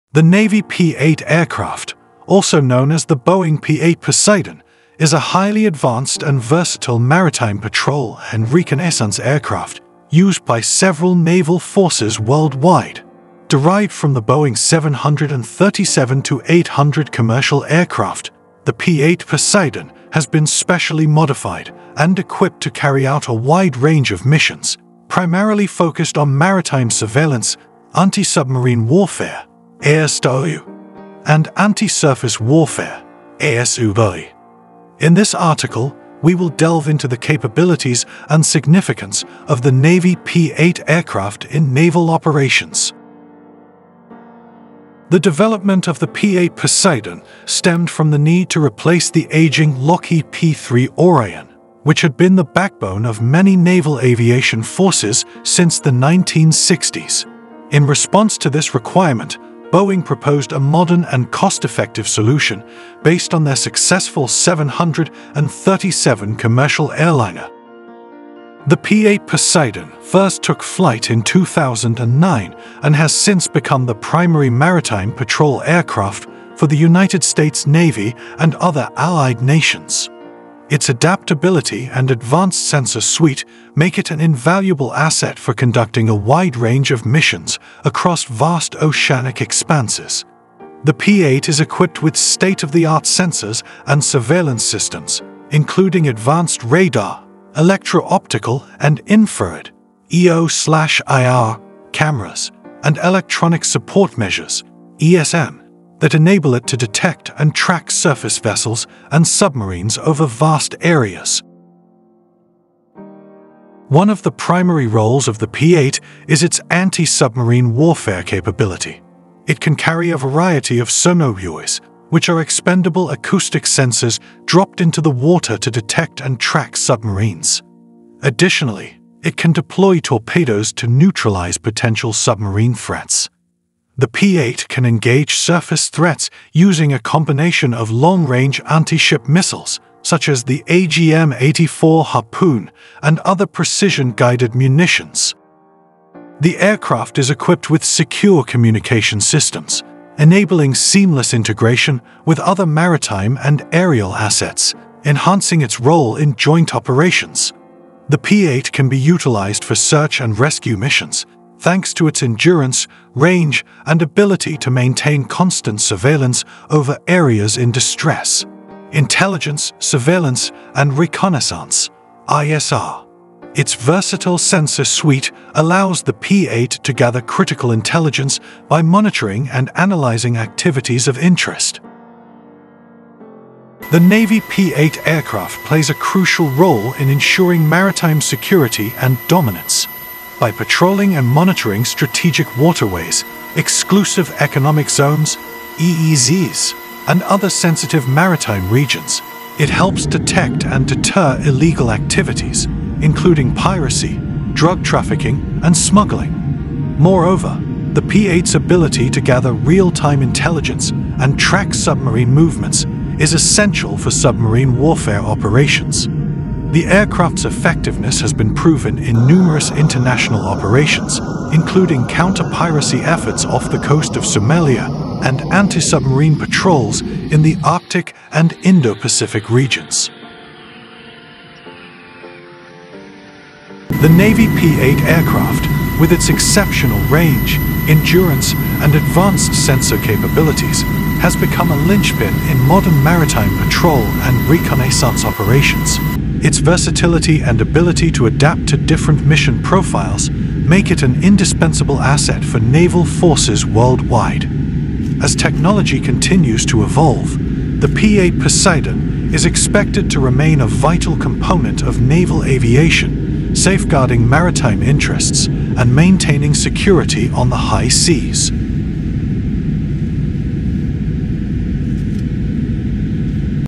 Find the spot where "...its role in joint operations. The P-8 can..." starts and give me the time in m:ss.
2:35.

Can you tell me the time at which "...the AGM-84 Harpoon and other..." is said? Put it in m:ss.
2:20.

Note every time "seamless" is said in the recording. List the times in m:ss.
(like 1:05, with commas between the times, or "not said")
2:30.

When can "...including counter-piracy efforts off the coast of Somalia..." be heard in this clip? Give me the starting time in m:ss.
3:41.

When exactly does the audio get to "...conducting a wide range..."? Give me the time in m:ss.
1:25.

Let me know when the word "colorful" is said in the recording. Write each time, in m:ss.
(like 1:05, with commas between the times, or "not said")
not said.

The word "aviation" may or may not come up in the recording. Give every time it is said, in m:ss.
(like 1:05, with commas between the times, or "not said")
0:53, 4:22.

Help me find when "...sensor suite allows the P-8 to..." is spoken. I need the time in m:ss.
2:54.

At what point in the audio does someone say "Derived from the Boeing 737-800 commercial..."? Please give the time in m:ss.
0:13.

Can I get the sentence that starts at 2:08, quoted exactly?
Additionally, it can deploy torpedoes to neutralize potential submarine threats.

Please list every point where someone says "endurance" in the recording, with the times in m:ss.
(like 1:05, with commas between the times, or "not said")
2:42, 3:57.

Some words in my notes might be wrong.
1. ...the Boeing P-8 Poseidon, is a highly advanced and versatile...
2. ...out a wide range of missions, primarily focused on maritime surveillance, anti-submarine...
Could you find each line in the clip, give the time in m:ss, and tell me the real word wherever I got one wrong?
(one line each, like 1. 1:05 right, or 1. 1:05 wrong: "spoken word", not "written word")
1. 0:03 right
2. 0:23 right.